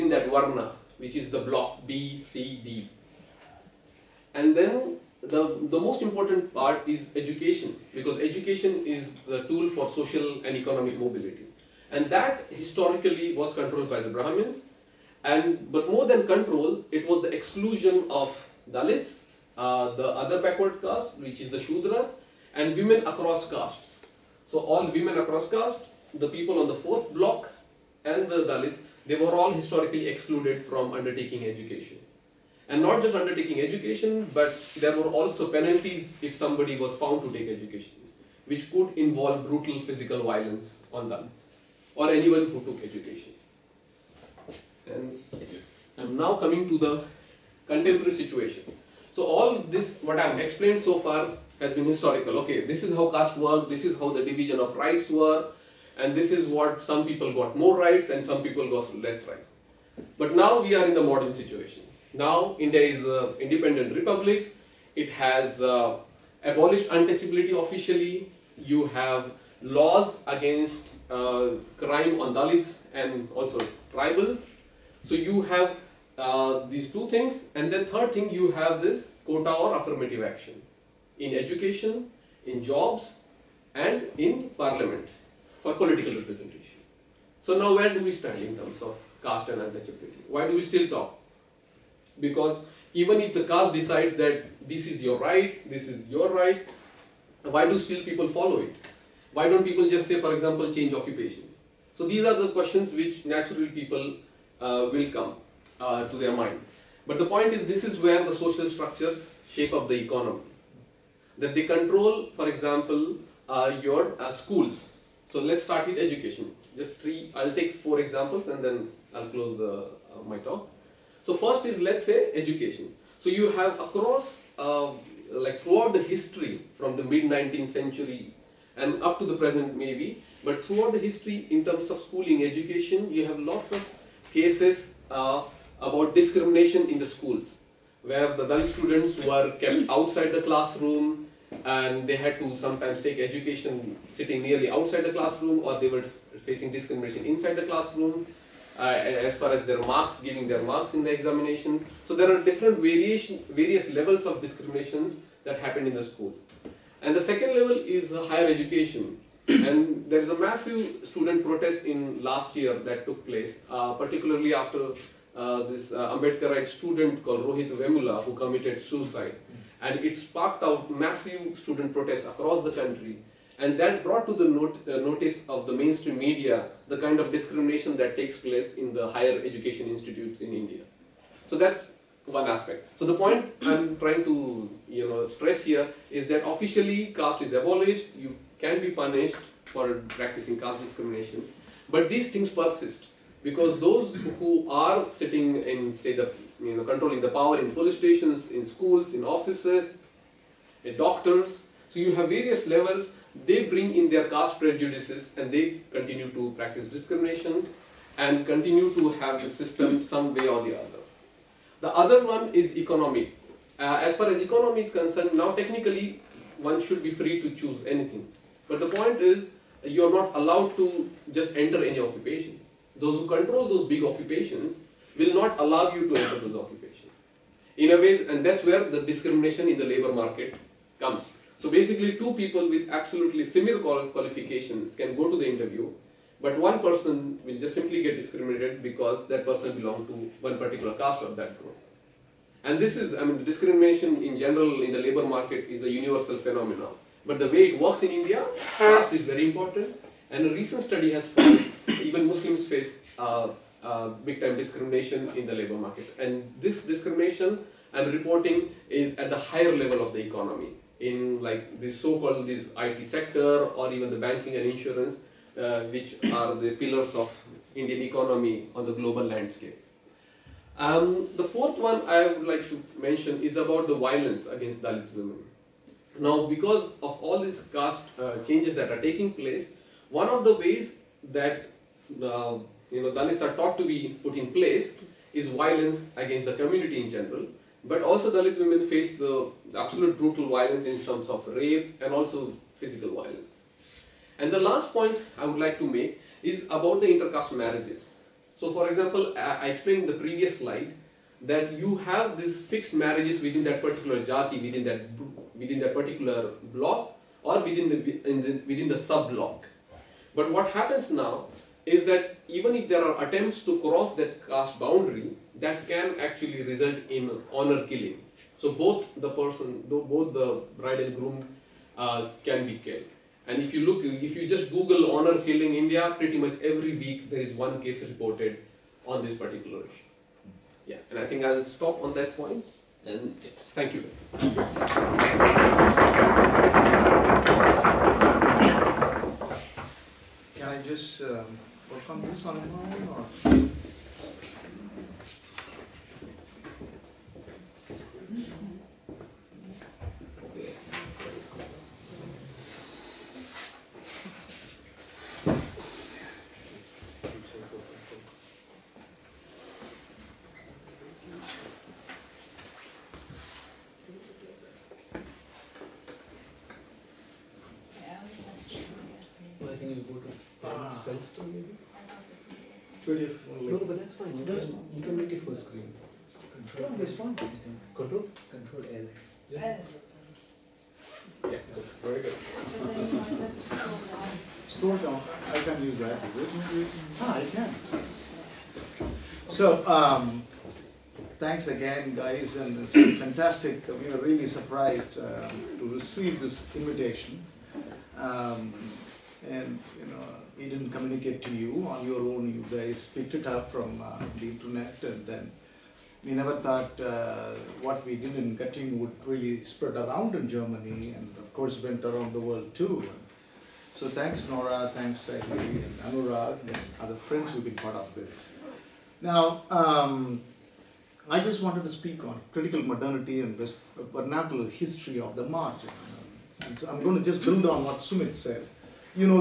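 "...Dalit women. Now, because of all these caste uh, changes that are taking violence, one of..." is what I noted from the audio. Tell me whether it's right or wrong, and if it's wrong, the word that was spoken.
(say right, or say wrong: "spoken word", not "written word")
wrong: "place", not "violence".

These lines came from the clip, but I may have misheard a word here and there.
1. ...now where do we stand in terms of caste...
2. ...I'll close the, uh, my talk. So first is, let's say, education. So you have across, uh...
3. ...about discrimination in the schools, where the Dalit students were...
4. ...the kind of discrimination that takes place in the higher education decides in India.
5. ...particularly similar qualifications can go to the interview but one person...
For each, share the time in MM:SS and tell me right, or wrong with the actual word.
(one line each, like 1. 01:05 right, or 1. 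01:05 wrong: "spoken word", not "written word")
1. 01:27 right
2. 01:59 right
3. 02:15 right
4. 02:56 wrong: "institutes", not "decides"
5. 03:52 wrong: "absolutely", not "particularly".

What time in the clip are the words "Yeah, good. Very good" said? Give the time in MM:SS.
06:21.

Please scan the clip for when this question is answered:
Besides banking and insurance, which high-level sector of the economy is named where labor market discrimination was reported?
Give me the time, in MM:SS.
04:22.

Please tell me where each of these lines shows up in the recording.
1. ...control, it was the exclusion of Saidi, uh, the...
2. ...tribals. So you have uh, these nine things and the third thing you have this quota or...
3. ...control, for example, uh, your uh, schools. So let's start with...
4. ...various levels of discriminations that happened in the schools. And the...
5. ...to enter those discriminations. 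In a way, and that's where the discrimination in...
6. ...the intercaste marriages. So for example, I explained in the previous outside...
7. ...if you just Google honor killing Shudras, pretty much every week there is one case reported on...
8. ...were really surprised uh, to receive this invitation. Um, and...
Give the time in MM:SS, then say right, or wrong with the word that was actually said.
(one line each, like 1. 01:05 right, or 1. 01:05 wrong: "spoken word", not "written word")
1. 00:16 wrong: "Dalits", not "Saidi"
2. 01:13 wrong: "two", not "nine"
3. 01:51 right
4. 02:33 right
5. 03:46 wrong: "occupations", not "discriminations"
6. 04:57 wrong: "slide", not "outside"
7. 05:24 wrong: "India", not "Shudras"
8. 06:34 right.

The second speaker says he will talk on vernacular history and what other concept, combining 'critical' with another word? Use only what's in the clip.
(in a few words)
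Critical modernity.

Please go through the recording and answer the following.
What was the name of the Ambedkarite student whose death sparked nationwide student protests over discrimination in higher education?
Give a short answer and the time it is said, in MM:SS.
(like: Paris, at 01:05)
Rohit Vemula, at 02:47.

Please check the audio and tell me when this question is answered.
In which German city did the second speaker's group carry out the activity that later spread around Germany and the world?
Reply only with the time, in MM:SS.
06:48.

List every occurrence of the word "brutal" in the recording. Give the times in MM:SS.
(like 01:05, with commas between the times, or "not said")
00:39, 04:50.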